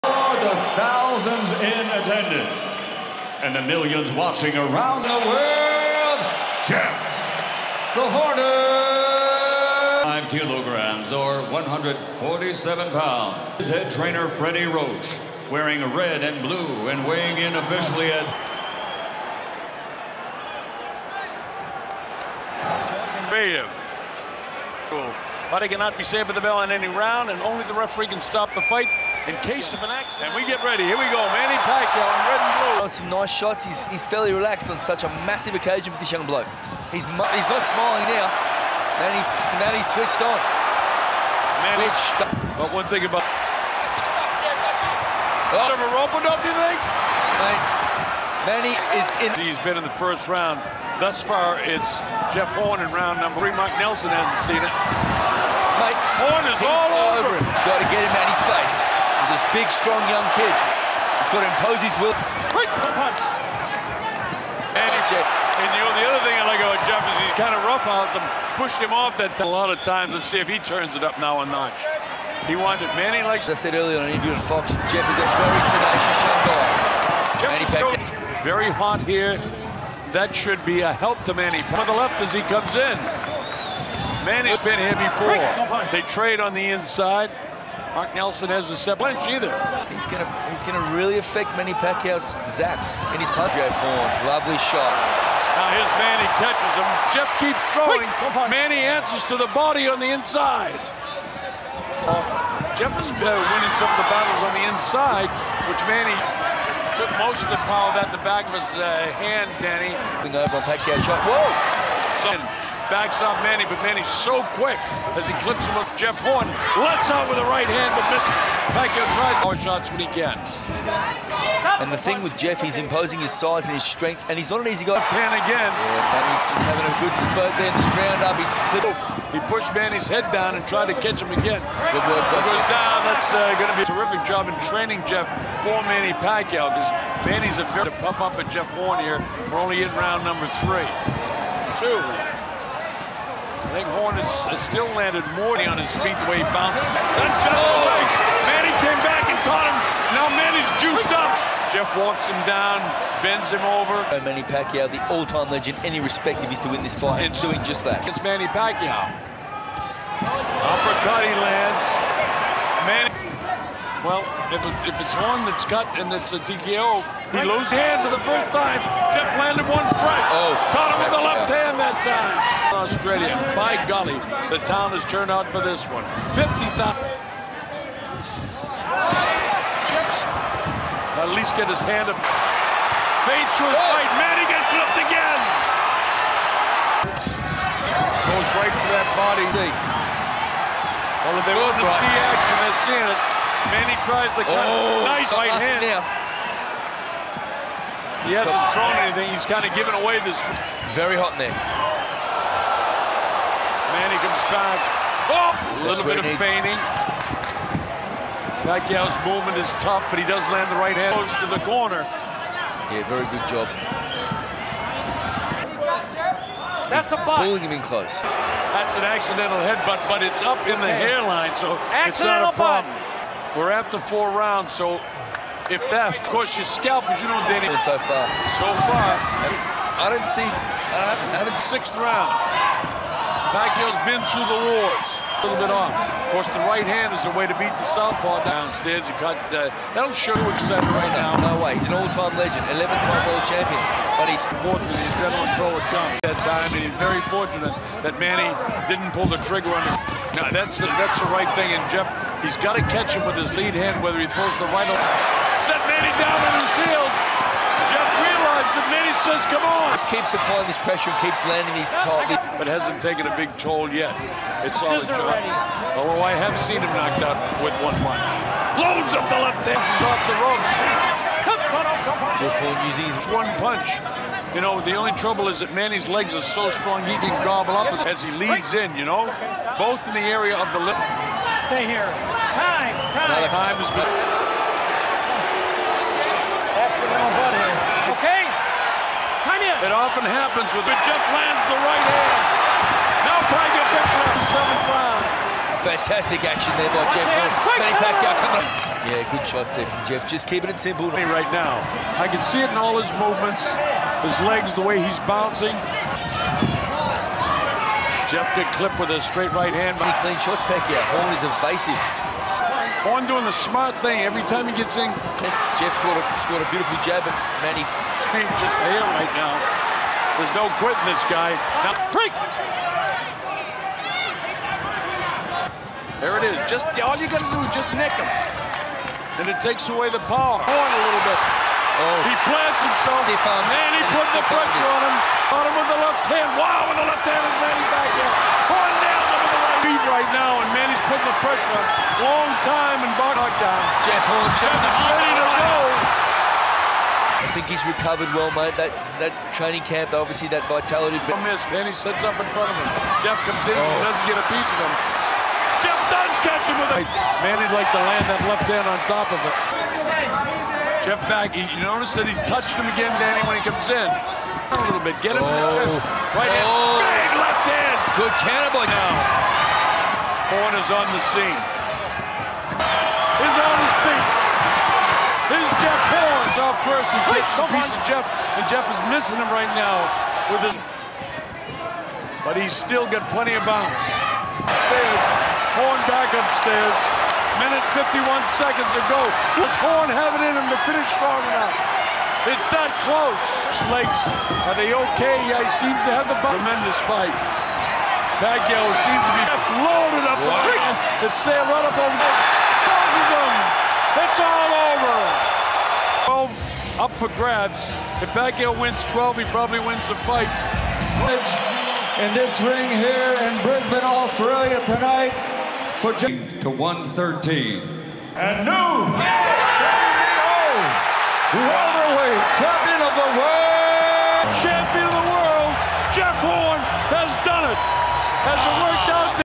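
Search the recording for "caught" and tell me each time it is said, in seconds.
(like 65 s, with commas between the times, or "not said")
149 s, 170 s.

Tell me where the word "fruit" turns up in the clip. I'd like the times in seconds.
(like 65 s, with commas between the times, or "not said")
not said.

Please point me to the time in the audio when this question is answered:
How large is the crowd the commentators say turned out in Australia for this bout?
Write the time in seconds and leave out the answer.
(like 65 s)
176 s.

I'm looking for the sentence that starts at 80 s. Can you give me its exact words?
That should be a help to Manny.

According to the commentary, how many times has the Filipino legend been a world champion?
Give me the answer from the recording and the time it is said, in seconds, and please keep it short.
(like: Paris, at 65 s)
11, at 242 s.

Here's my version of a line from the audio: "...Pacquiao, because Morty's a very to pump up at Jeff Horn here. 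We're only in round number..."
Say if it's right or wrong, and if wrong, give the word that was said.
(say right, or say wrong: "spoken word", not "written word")
wrong: "Manny", not "Morty".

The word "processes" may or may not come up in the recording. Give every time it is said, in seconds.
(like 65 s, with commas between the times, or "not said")
not said.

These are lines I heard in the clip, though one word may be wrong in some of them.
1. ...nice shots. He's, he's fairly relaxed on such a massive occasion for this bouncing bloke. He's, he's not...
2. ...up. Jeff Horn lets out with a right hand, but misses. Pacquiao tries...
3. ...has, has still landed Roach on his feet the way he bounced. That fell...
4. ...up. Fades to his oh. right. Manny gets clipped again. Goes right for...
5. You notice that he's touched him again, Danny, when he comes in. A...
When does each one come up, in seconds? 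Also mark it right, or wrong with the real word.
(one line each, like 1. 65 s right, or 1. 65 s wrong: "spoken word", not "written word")
1. 33 s wrong: "young", not "bouncing"
2. 115 s right
3. 144 s wrong: "Morty", not "Roach"
4. 182 s right
5. 361 s right.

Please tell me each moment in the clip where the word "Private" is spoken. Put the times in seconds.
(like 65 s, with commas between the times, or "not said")
293 s.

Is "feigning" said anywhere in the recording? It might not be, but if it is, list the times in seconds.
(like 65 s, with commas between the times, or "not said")
206 s.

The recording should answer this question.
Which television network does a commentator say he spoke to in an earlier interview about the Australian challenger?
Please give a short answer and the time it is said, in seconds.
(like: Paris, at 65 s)
Fox, at 74 s.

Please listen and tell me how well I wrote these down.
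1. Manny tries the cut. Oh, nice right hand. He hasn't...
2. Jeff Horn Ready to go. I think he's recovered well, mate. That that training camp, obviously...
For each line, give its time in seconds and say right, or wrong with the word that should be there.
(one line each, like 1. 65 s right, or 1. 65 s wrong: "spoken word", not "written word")
1. 193 s right
2. 344 s right.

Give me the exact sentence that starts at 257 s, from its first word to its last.
Jeff that Manny says, come on.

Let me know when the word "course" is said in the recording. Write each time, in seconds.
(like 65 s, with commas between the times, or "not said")
226 s, 236 s.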